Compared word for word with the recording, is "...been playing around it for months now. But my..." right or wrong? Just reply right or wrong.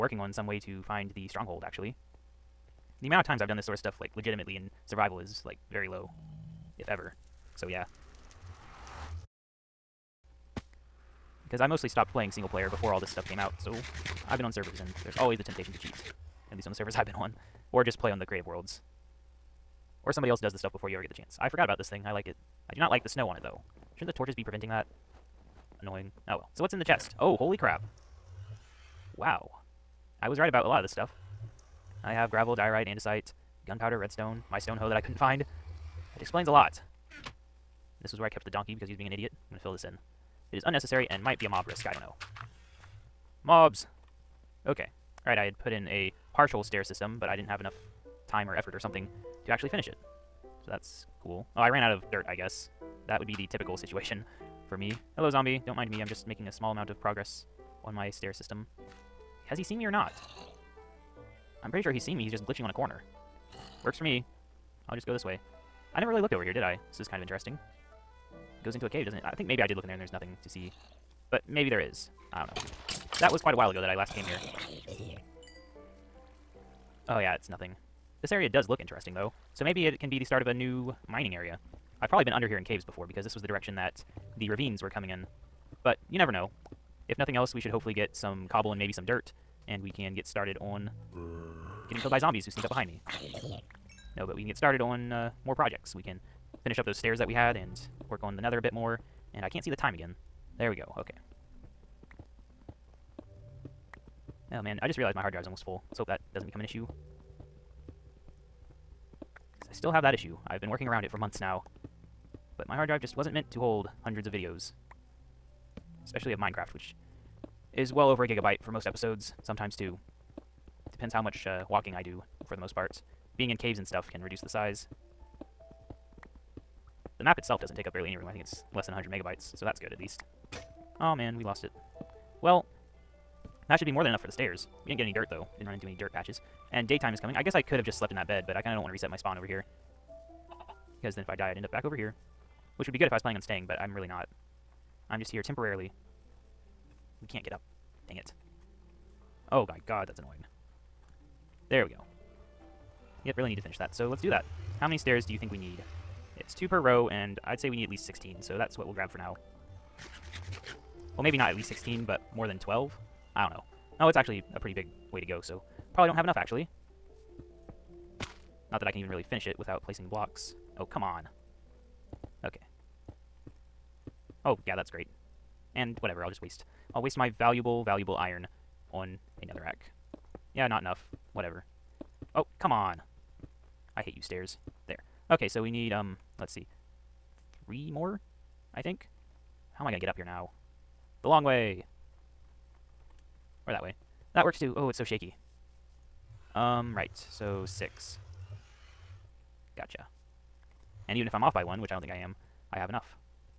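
wrong.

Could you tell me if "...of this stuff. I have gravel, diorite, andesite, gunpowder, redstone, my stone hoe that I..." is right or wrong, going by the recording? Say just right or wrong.
right.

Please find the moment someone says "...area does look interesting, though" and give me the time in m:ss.
1:18.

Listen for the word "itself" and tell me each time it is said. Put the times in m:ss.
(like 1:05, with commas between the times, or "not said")
2:07.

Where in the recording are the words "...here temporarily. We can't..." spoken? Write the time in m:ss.
2:25.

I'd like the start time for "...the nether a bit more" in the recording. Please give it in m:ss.
1:38.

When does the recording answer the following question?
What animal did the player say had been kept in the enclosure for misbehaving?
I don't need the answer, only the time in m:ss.
0:38.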